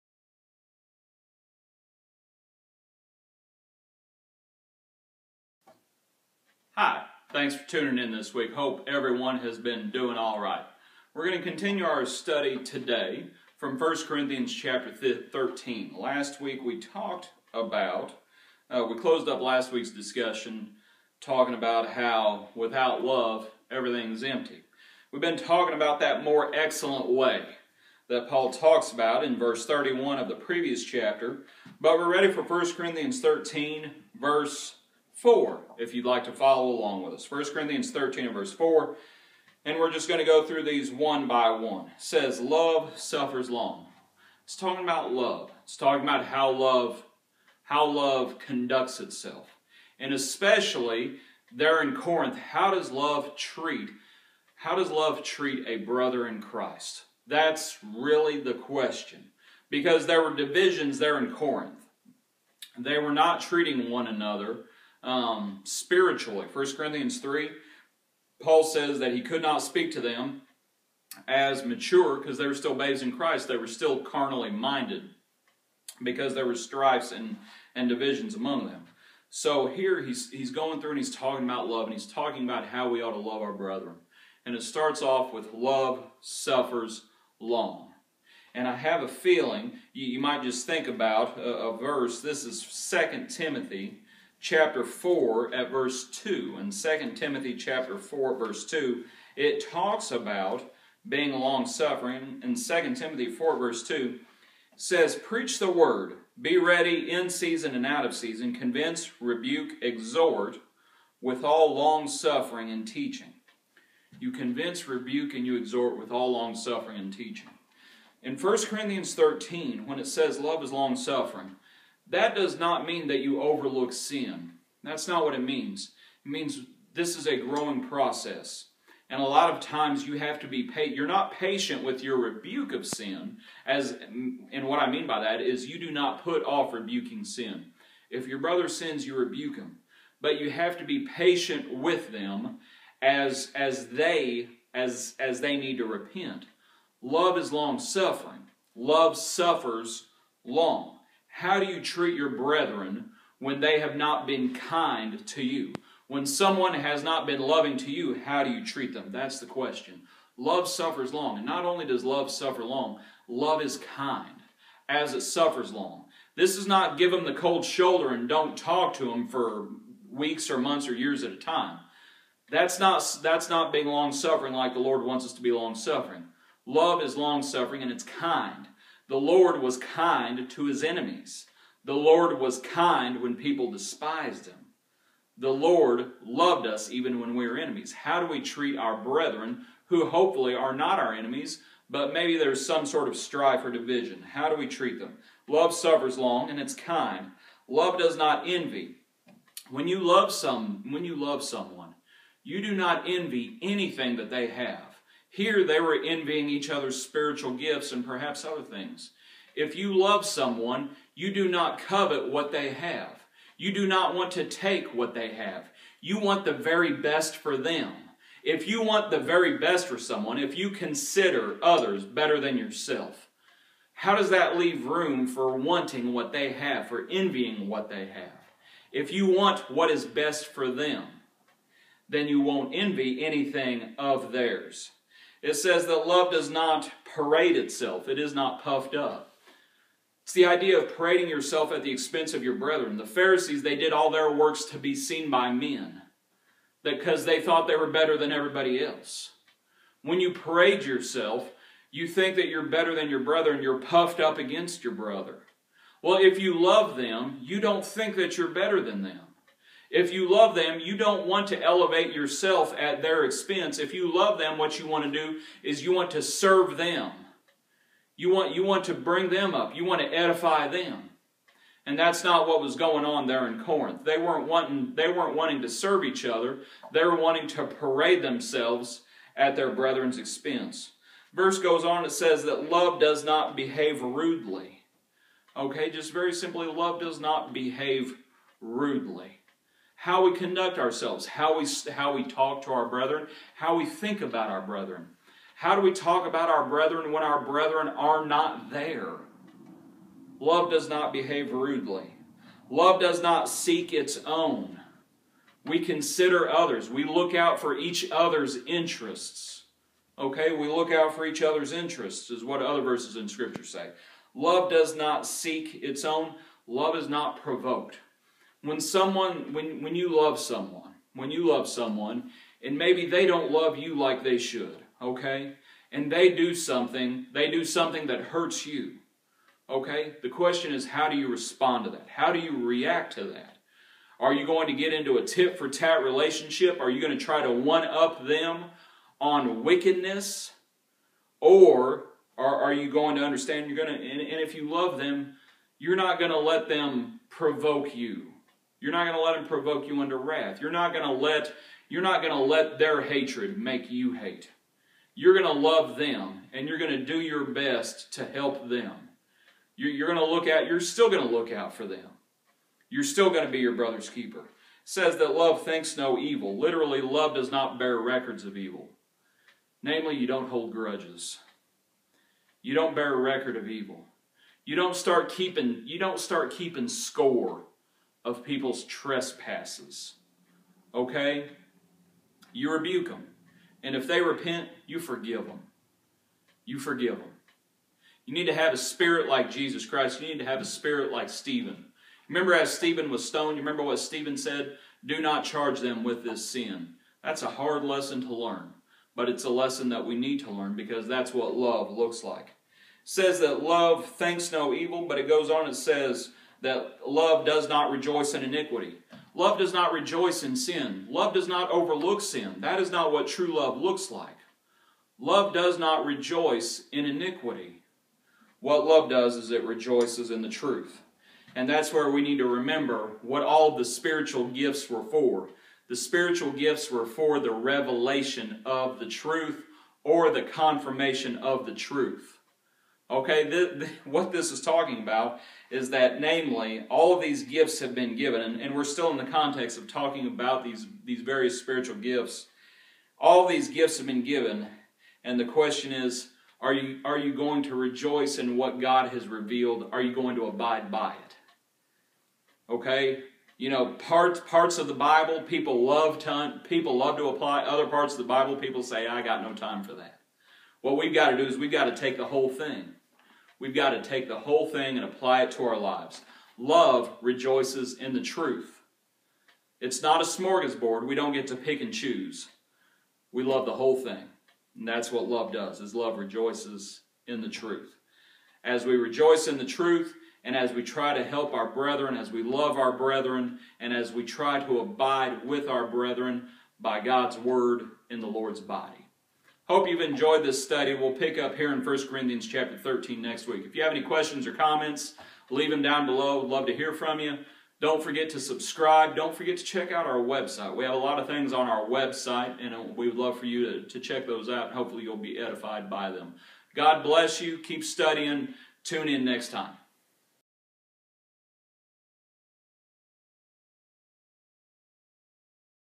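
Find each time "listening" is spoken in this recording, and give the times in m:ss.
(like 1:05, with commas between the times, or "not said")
not said.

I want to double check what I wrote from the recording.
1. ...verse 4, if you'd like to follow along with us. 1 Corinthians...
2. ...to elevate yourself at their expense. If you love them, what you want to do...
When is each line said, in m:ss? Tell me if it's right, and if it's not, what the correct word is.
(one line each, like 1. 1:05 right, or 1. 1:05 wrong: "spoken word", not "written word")
1. 0:34 right
2. 4:21 right.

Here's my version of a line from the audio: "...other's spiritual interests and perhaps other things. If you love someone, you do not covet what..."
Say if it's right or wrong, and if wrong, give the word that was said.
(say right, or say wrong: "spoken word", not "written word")
wrong: "gifts", not "interests".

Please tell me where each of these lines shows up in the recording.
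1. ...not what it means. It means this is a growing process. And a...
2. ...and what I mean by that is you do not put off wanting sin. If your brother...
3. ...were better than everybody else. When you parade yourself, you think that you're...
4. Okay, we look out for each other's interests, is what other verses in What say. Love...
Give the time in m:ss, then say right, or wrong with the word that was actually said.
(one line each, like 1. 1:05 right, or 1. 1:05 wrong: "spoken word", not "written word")
1. 2:05 right
2. 2:14 wrong: "rebuking", not "wanting"
3. 4:07 right
4. 5:10 wrong: "Scripture", not "What".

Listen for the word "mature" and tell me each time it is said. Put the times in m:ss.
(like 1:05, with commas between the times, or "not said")
1:11.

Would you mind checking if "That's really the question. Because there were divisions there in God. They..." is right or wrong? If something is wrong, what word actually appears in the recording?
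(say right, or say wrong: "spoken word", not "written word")
wrong: "Corinth", not "God".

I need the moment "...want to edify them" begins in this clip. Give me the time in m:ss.
4:29.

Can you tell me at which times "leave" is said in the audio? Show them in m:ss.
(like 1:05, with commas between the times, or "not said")
3:44, 8:15.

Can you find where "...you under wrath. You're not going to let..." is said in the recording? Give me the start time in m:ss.
5:49.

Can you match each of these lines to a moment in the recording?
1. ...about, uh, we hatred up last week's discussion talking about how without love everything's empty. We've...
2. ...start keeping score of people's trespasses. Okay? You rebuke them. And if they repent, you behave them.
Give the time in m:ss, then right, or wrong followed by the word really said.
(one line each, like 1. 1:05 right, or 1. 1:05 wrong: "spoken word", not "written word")
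1. 0:17 wrong: "closed", not "hatred"
2. 6:16 wrong: "forgive", not "behave".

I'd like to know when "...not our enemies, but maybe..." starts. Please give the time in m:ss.
3:10.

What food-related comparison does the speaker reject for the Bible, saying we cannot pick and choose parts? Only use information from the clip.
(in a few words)
A smorgasbord.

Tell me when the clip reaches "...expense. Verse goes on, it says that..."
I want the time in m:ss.
4:40.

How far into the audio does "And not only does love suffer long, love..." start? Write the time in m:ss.
2:41.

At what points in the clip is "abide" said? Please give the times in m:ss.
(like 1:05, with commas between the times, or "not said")
7:30, 8:04.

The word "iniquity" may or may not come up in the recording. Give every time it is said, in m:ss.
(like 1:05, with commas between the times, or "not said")
6:48, 6:57.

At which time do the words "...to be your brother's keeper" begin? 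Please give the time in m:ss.
6:03.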